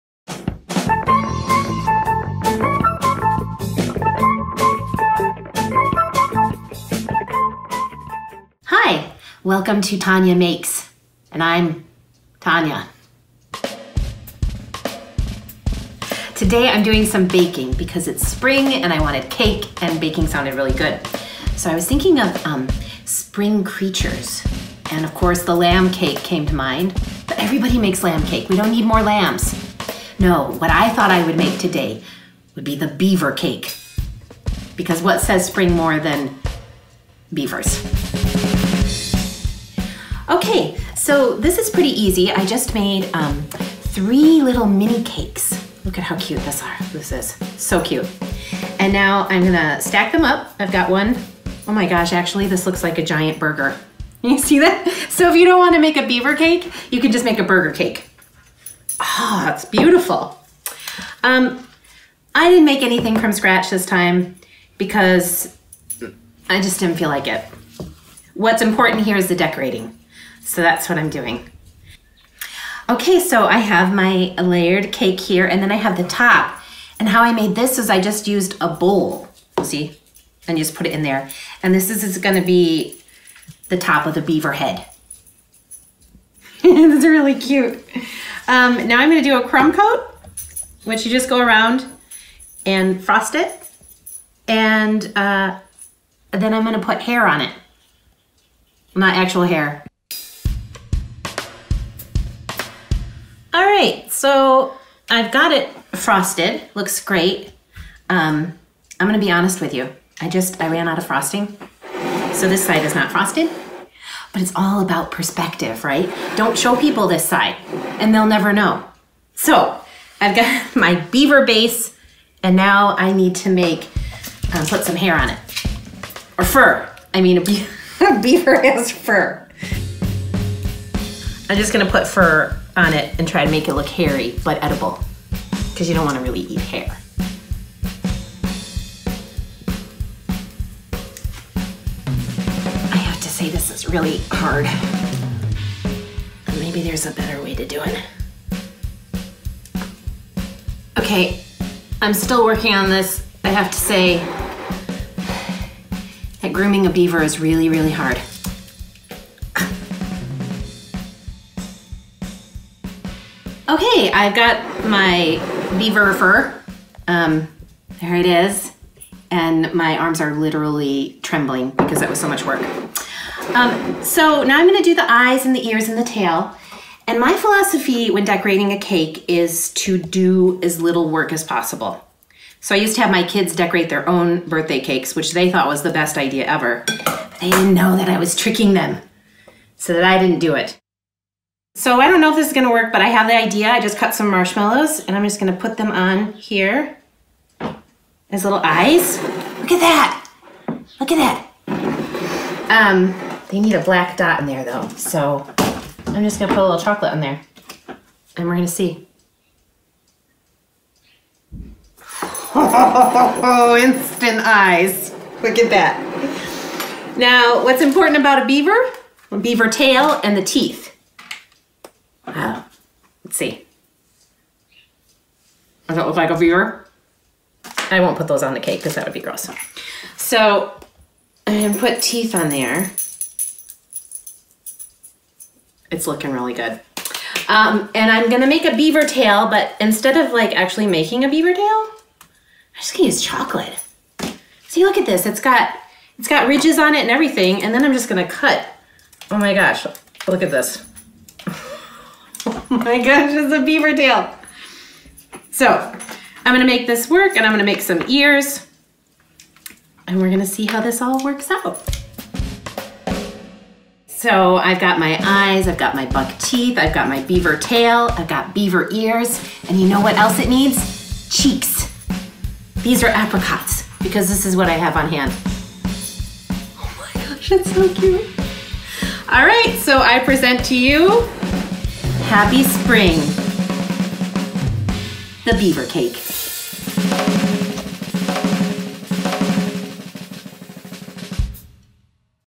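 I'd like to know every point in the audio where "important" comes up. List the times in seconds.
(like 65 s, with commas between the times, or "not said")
68 s, 217 s.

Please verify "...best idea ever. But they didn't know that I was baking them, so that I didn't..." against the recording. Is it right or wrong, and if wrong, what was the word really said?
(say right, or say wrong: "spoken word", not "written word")
wrong: "tricking", not "baking".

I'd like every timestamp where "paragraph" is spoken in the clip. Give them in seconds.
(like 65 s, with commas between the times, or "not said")
not said.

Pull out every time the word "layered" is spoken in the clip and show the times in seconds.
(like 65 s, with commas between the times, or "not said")
74 s.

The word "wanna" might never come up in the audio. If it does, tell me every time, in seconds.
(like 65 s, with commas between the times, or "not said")
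55 s.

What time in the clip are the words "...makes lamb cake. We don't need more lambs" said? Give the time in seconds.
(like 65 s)
27 s.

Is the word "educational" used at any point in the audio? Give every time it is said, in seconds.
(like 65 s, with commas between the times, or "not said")
not said.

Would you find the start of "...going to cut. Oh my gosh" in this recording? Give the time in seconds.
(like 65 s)
248 s.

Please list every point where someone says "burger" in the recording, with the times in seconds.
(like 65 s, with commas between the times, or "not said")
53 s, 57 s.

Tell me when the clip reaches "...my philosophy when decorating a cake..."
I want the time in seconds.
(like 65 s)
177 s.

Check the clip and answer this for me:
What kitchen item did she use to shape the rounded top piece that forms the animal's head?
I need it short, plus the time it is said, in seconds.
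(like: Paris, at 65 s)
A bowl, at 78 s.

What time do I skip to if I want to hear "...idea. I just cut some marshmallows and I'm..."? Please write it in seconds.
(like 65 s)
193 s.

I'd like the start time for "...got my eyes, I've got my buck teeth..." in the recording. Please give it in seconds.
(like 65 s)
264 s.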